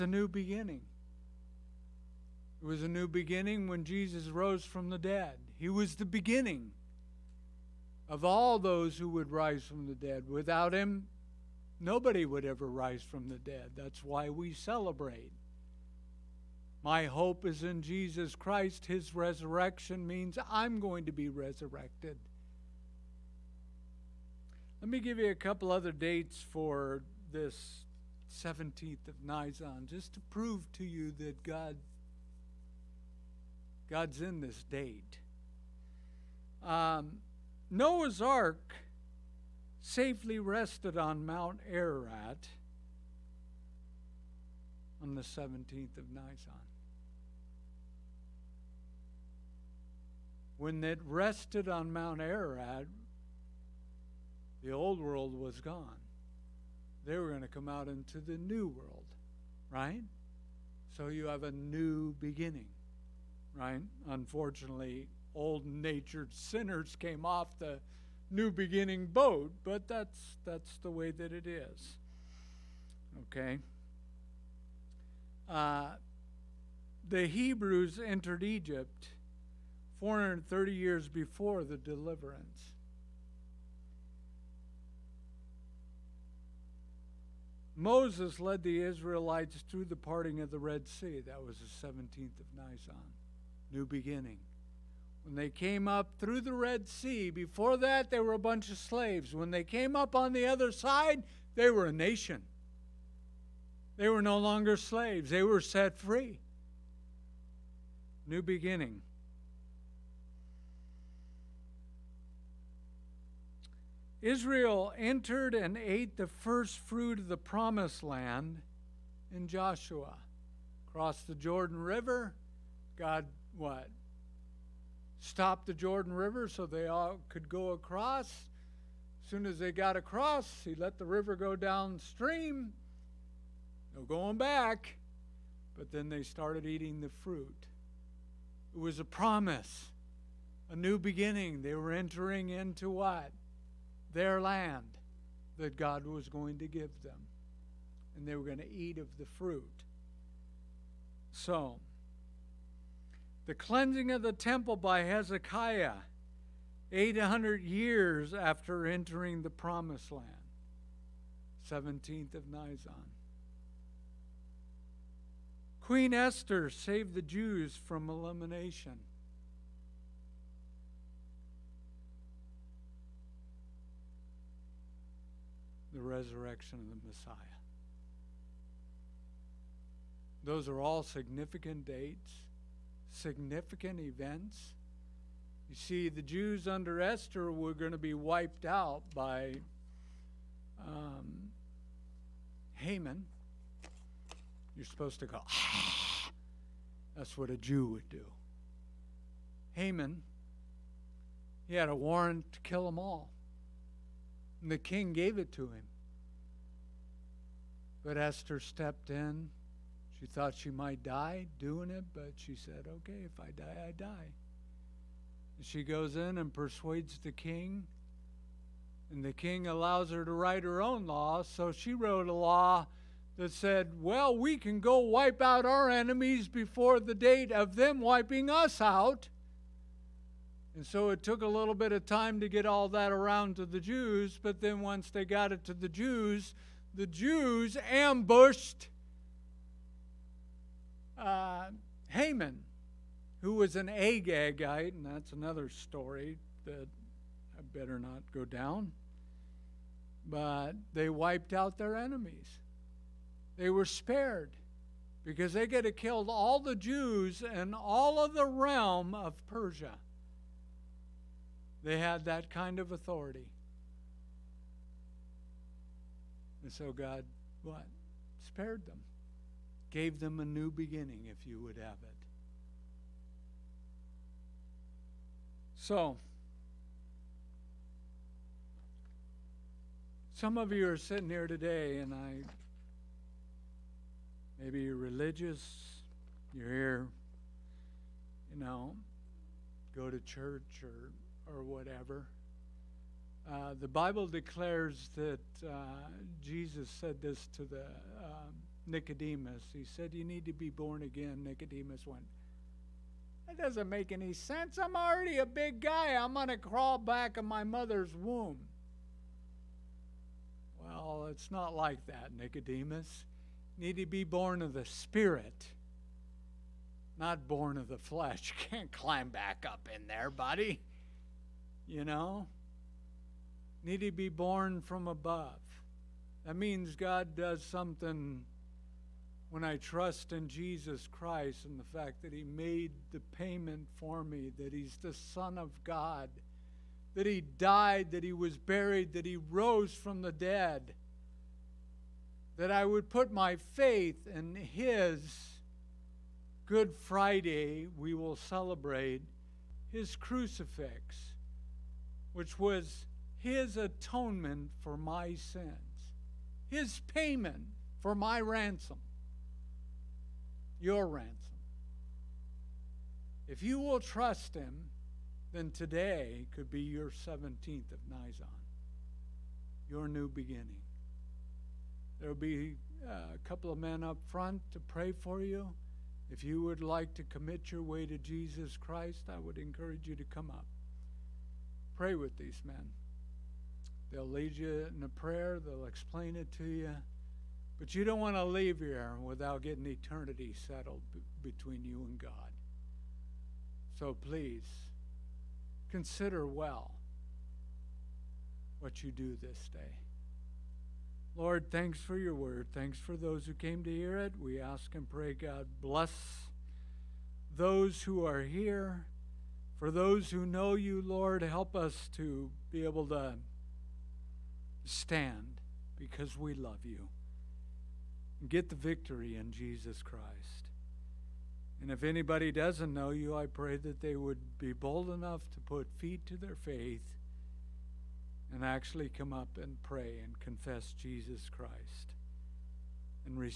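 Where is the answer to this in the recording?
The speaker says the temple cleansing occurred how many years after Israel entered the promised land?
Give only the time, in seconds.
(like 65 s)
156 s.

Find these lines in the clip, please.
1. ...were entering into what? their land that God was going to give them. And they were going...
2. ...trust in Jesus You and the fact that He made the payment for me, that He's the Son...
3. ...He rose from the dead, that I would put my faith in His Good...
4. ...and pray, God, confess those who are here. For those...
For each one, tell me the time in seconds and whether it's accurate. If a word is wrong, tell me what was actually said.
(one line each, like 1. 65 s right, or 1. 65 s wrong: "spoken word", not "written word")
1. 141 s right
2. 329 s wrong: "Christ", not "You"
3. 339 s right
4. 404 s wrong: "bless", not "confess".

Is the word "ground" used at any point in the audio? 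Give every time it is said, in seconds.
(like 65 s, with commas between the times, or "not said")
not said.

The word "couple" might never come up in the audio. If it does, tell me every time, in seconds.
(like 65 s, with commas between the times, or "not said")
25 s, 373 s.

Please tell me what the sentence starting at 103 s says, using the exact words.
They were no longer slaves, they were set free.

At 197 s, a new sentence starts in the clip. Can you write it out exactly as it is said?
that's what a Jew would do.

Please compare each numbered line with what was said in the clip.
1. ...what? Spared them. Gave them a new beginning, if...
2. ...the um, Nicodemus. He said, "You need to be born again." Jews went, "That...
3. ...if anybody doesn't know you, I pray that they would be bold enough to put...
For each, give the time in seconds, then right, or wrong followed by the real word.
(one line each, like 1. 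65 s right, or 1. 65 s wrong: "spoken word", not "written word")
1. 267 s right
2. 297 s wrong: "Nicodemus", not "Jews"
3. 421 s right.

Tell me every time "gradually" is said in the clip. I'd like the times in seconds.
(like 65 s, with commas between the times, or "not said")
not said.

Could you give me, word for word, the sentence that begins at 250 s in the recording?
But they wiped out their enemies.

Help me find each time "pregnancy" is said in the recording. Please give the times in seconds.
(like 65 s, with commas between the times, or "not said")
not said.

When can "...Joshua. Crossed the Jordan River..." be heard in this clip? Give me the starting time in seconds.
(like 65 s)
119 s.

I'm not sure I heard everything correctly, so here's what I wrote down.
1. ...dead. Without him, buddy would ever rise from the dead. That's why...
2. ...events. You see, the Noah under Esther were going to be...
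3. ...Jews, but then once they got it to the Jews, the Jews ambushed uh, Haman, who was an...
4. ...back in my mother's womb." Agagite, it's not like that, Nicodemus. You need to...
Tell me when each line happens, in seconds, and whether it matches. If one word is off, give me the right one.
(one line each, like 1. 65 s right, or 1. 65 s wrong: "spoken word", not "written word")
1. 9 s wrong: "nobody", not "buddy"
2. 183 s wrong: "Jews", not "Noah"
3. 233 s right
4. 306 s wrong: "Well", not "Agagite".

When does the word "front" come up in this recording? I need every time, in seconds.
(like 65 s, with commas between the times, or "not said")
374 s.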